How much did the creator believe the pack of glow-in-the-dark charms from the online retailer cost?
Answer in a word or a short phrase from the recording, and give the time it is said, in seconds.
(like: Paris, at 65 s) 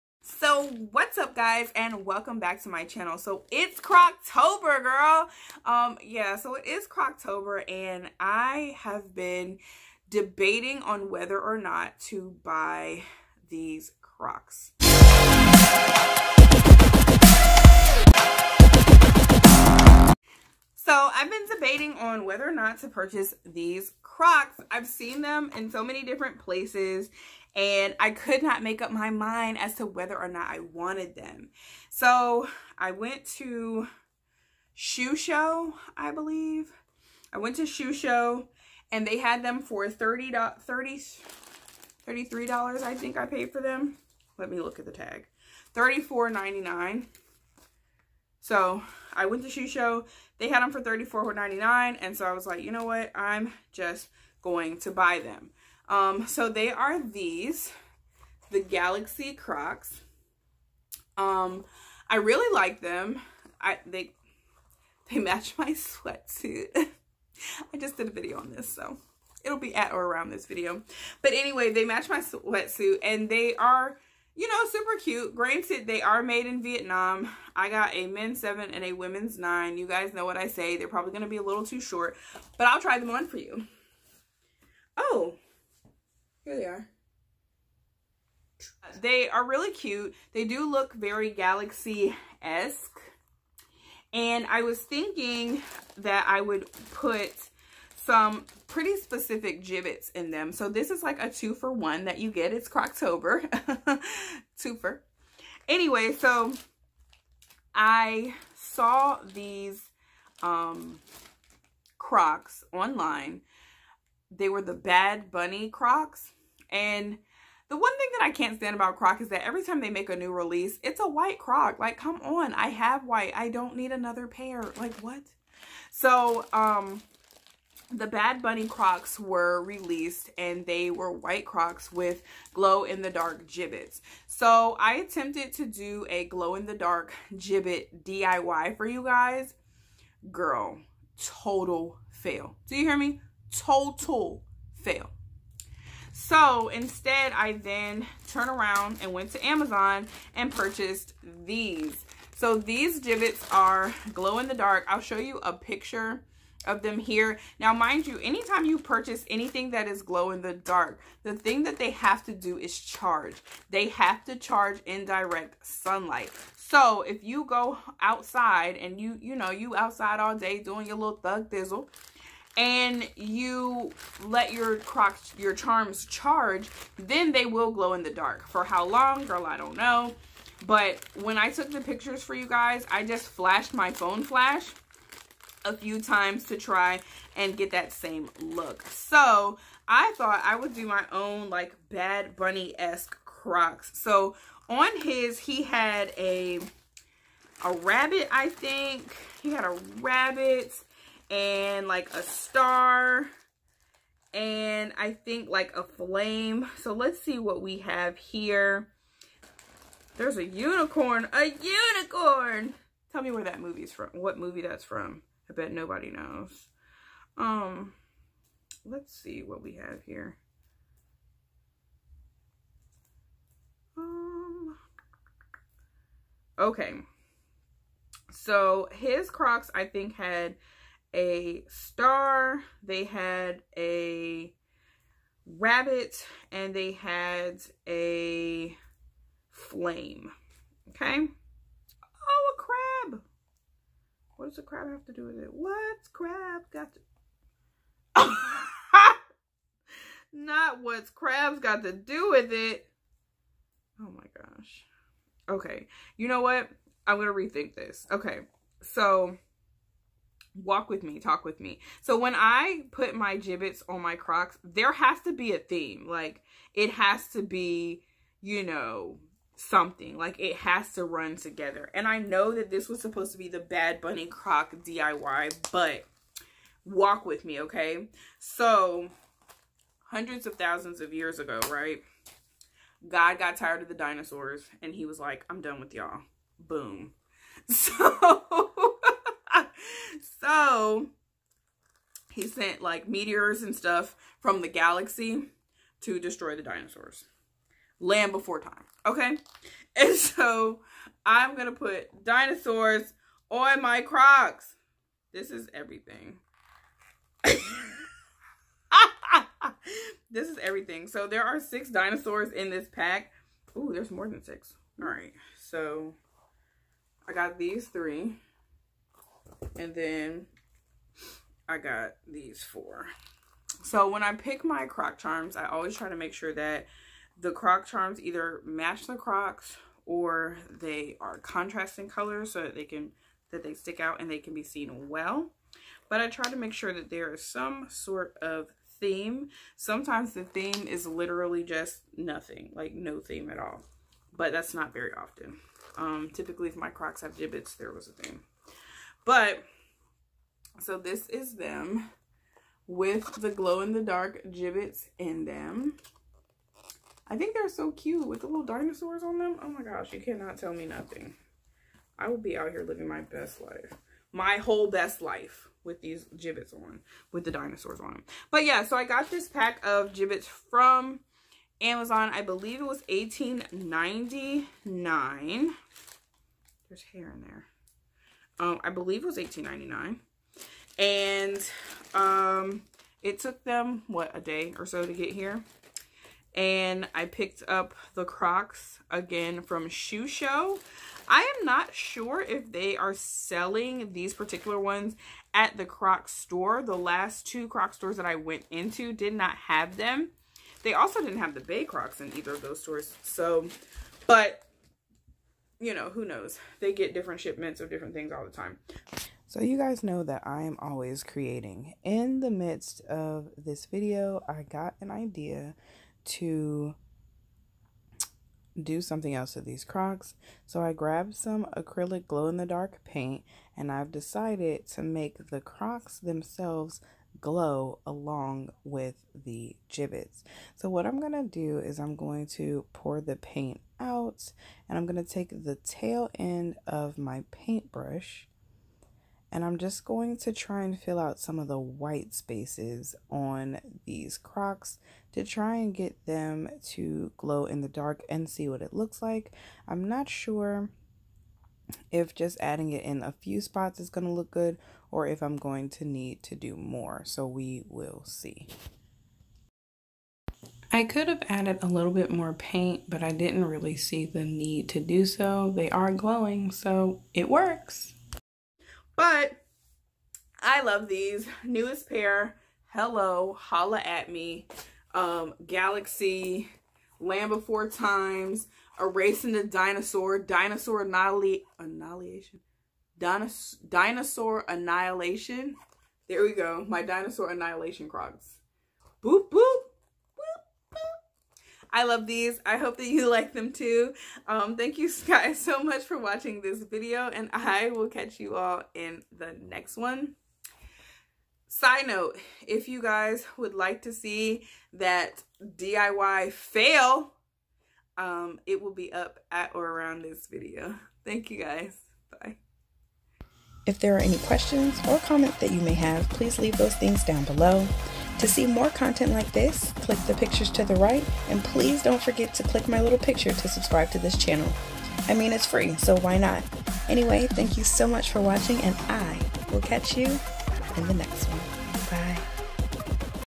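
$18.99, at 379 s.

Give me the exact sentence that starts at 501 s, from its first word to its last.
Side note, if you guys would like to see that DIY fail, um, it will be up at or around this video.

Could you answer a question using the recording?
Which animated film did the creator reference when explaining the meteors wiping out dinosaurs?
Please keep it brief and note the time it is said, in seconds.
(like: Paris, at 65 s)
Land Before Time, at 297 s.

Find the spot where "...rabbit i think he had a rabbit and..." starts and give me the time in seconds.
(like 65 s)
197 s.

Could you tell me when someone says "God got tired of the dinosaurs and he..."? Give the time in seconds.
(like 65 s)
283 s.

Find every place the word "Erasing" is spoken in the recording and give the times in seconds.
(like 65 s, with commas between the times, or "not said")
478 s.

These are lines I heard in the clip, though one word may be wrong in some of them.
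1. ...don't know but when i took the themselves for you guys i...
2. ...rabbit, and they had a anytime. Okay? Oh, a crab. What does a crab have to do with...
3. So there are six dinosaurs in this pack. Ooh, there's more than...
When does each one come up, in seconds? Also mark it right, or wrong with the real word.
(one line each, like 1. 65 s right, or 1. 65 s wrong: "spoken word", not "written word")
1. 179 s wrong: "pictures", not "themselves"
2. 235 s wrong: "flame", not "anytime"
3. 311 s right.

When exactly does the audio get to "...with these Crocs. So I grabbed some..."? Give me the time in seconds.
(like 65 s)
419 s.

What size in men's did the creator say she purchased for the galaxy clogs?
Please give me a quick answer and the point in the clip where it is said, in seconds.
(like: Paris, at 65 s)
7, at 78 s.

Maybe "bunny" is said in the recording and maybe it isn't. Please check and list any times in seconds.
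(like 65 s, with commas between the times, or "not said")
115 s, 128 s, 192 s, 274 s.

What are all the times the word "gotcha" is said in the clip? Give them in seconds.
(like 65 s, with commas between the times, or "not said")
not said.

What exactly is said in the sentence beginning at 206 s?
So let's see what we have here.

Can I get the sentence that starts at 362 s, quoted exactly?
I will be out here living my best life.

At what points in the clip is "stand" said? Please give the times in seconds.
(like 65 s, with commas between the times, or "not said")
118 s.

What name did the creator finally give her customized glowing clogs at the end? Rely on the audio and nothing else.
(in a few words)
Dinosaur Annihilation Crocs.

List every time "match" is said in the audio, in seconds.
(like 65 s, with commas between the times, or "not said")
65 s, 71 s, 328 s.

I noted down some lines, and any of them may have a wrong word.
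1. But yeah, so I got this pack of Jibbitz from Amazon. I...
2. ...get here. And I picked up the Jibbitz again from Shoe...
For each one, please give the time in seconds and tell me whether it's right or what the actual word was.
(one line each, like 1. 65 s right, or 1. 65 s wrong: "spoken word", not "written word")
1. 368 s right
2. 385 s wrong: "Crocs", not "Jibbitz".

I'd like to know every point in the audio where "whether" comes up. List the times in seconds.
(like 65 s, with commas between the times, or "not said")
11 s, 22 s, 29 s.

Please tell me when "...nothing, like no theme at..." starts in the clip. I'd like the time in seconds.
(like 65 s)
342 s.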